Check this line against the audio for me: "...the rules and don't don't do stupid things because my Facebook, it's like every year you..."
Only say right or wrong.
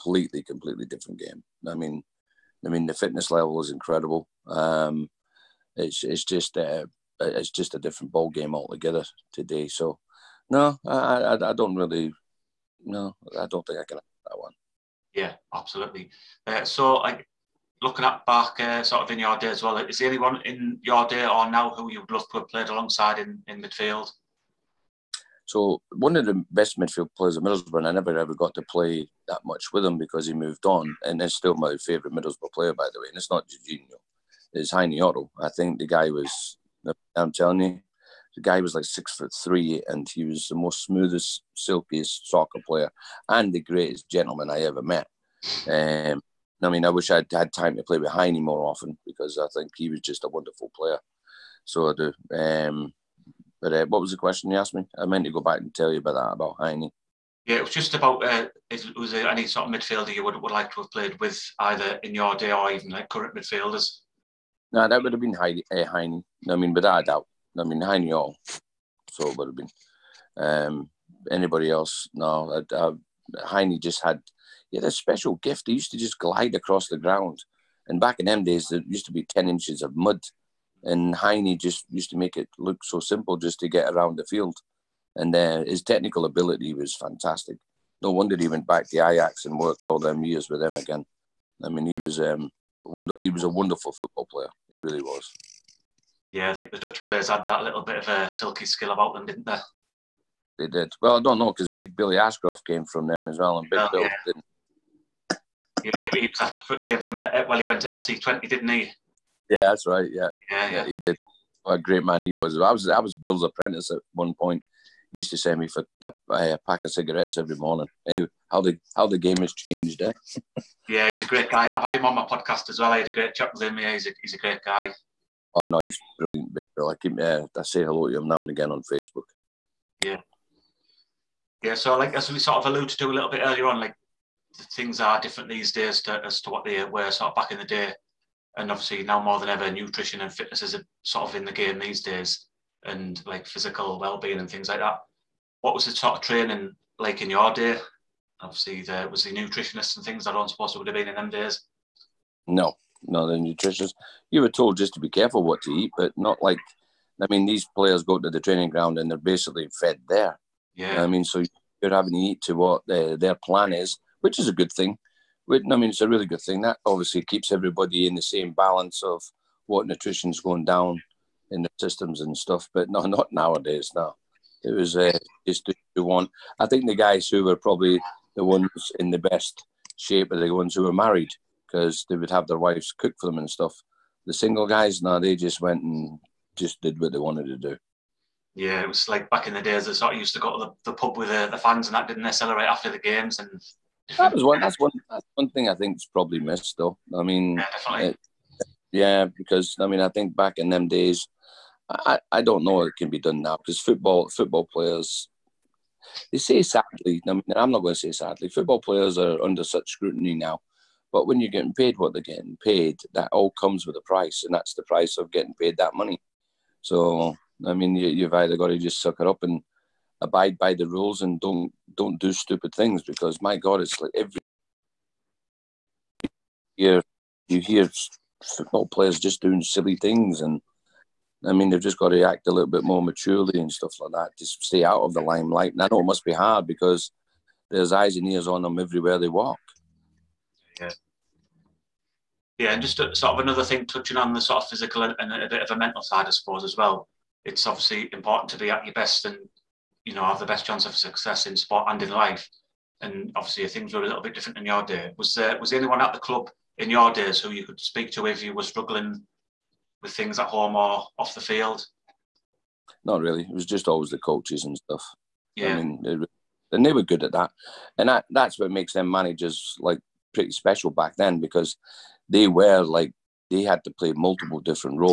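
wrong.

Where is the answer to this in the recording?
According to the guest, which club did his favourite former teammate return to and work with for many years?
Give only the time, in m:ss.
1:29.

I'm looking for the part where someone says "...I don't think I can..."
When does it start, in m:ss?
0:13.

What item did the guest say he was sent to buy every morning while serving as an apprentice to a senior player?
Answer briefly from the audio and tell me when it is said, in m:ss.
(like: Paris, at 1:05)
a pack of cigarettes, at 1:56.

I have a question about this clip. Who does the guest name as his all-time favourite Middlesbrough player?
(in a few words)
Heine Otto.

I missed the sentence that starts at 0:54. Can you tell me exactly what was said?
I meant to go back and tell you about that about Heine.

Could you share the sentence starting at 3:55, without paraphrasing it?
And I know it must be hard because there's eyes and ears on them everywhere they walk.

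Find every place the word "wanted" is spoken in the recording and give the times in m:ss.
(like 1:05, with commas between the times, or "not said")
3:07.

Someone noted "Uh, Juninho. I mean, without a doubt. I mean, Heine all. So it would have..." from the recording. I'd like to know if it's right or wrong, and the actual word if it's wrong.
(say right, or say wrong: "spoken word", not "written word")
wrong: "Heine", not "Juninho".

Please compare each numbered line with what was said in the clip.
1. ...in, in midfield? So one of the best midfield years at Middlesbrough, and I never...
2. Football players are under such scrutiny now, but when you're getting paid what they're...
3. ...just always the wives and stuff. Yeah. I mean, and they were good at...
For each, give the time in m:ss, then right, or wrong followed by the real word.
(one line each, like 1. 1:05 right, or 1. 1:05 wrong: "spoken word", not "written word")
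1. 0:23 wrong: "players", not "years"
2. 3:28 right
3. 4:23 wrong: "coaches", not "wives".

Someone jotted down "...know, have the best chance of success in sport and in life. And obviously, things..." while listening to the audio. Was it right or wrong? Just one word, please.
right.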